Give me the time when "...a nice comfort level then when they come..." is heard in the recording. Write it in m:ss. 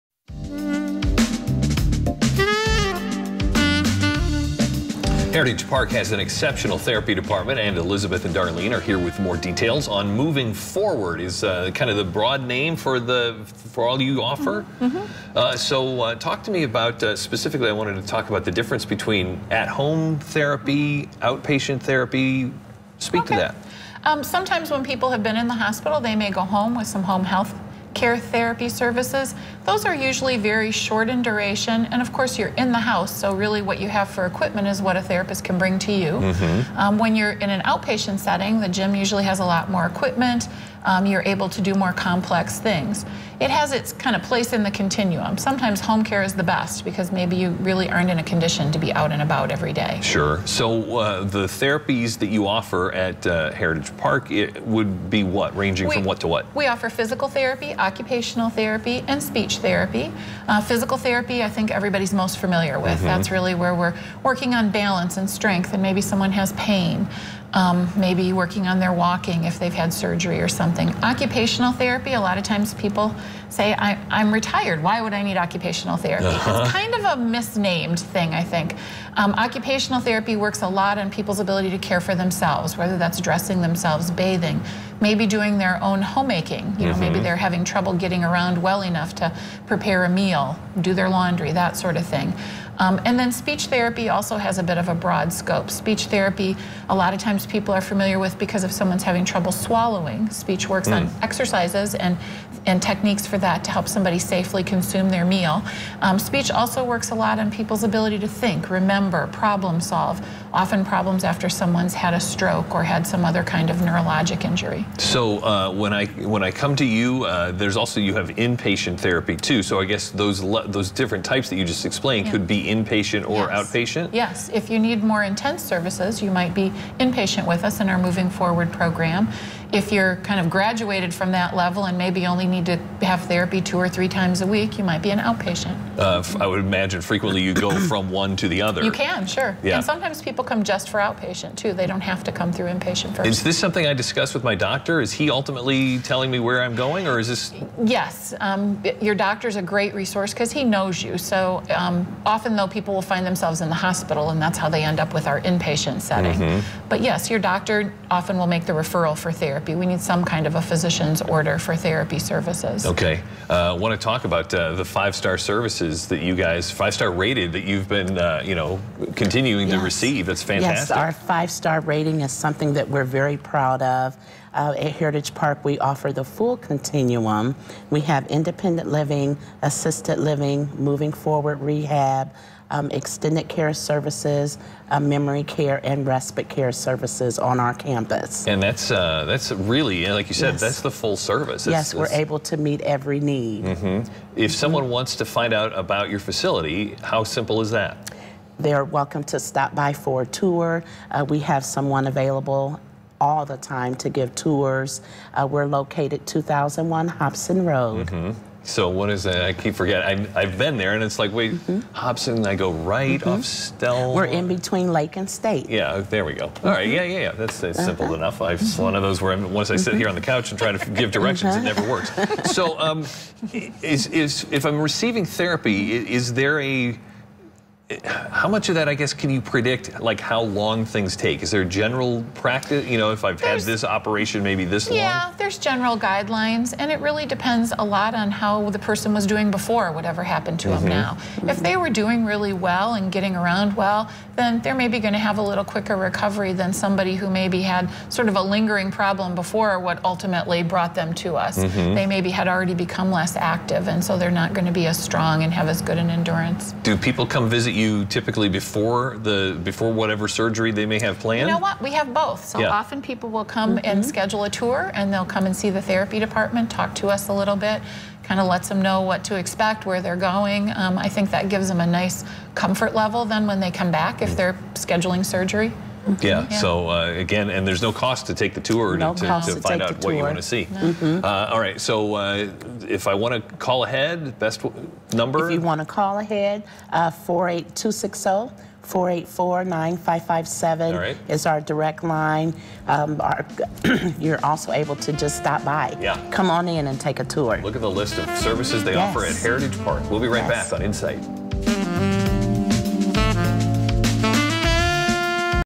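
4:31.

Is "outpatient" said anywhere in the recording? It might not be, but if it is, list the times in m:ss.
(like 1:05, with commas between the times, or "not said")
0:21, 0:37, 2:03, 2:15, 2:20.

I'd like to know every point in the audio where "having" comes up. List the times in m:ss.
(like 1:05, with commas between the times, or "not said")
1:27, 1:39.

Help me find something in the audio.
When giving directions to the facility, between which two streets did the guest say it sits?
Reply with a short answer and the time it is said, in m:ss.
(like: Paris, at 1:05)
Lake and State, at 3:34.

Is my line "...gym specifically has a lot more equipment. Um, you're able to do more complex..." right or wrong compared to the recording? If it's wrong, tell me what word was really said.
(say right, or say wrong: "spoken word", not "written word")
wrong: "usually", not "specifically".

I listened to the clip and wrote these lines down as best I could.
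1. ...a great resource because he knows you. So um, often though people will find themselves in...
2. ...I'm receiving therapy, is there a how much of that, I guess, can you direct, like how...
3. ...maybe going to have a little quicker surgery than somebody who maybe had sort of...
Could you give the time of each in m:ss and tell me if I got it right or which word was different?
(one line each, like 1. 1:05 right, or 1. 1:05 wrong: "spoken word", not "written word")
1. 2:29 right
2. 3:44 wrong: "predict", not "direct"
3. 4:04 wrong: "recovery", not "surgery".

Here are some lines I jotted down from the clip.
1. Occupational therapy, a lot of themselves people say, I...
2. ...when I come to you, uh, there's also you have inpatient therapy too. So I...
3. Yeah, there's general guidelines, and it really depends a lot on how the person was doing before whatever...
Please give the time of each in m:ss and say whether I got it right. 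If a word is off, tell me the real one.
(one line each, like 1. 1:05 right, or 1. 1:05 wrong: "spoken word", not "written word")
1. 1:11 wrong: "times", not "themselves"
2. 1:56 right
3. 3:55 right.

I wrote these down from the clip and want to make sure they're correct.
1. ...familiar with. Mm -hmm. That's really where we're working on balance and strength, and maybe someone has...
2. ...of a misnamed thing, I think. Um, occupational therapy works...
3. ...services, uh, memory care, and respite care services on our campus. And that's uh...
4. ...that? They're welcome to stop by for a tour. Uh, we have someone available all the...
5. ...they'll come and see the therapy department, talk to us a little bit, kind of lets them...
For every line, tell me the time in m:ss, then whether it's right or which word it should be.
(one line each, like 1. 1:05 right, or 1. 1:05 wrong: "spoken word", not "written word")
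1. 1:02 right
2. 1:16 right
3. 3:03 right
4. 3:17 right
5. 4:25 right.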